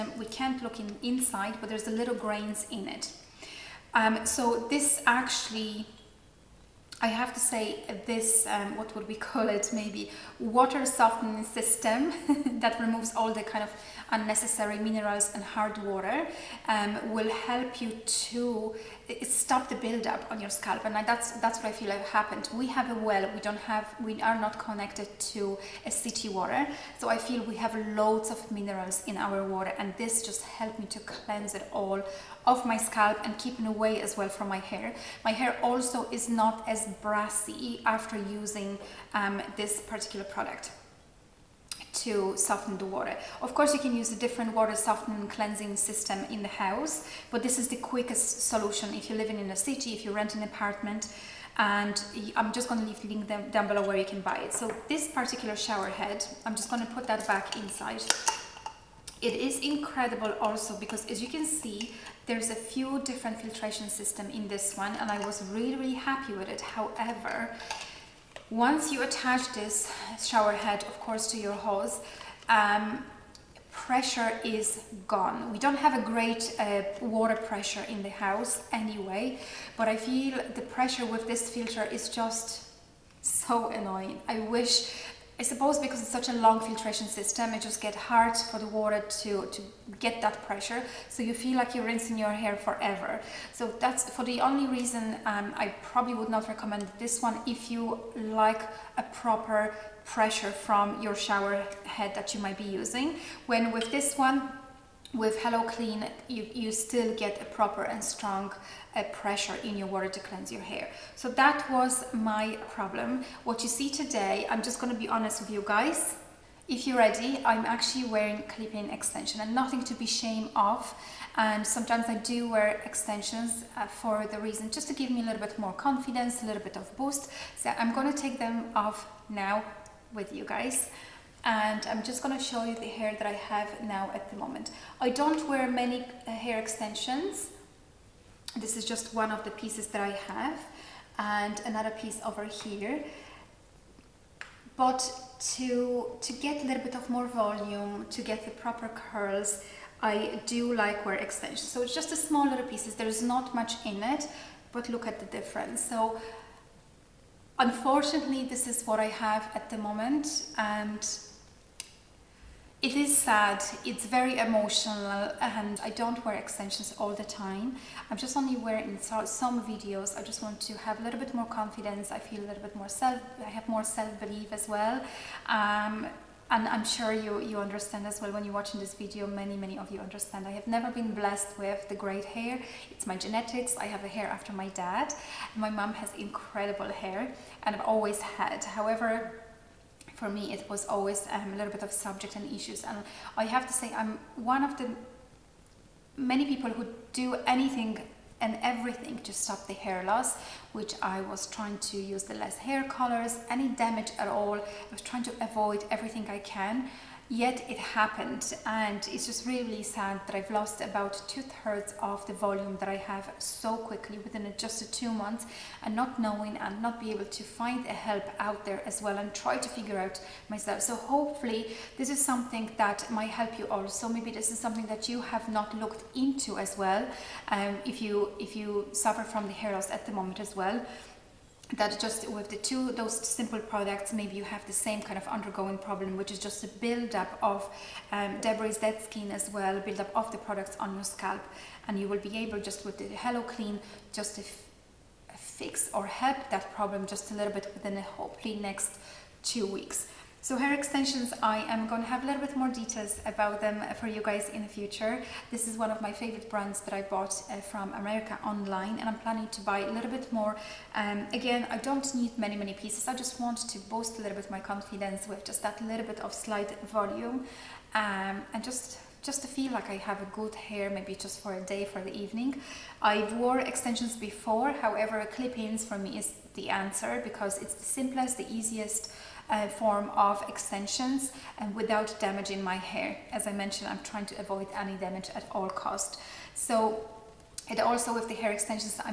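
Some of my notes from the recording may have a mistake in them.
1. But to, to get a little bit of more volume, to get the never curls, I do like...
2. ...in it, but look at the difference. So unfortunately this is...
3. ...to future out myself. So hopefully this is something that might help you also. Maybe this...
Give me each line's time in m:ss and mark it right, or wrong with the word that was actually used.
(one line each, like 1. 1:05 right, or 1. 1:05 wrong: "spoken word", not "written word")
1. 2:24 wrong: "proper", not "never"
2. 2:33 right
3. 3:39 wrong: "figure", not "future".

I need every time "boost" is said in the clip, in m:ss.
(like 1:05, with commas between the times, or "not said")
2:06, 4:23.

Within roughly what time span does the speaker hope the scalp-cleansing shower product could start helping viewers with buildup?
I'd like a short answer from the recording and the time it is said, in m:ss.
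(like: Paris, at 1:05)
2 weeks, at 4:09.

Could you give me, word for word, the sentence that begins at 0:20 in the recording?
And that's, that's what I feel have happened.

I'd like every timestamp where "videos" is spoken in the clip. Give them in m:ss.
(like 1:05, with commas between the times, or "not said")
2:49, 2:58.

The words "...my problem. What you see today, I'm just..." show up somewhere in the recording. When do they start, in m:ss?
1:52.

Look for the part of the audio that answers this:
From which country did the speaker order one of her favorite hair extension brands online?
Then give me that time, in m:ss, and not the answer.
4:17.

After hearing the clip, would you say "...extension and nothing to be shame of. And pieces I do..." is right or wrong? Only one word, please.
wrong.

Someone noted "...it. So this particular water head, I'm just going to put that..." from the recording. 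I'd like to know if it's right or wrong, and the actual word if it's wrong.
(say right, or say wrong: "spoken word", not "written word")
wrong: "shower", not "water".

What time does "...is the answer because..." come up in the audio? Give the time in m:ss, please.
4:36.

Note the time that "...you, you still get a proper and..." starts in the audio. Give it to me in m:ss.
1:46.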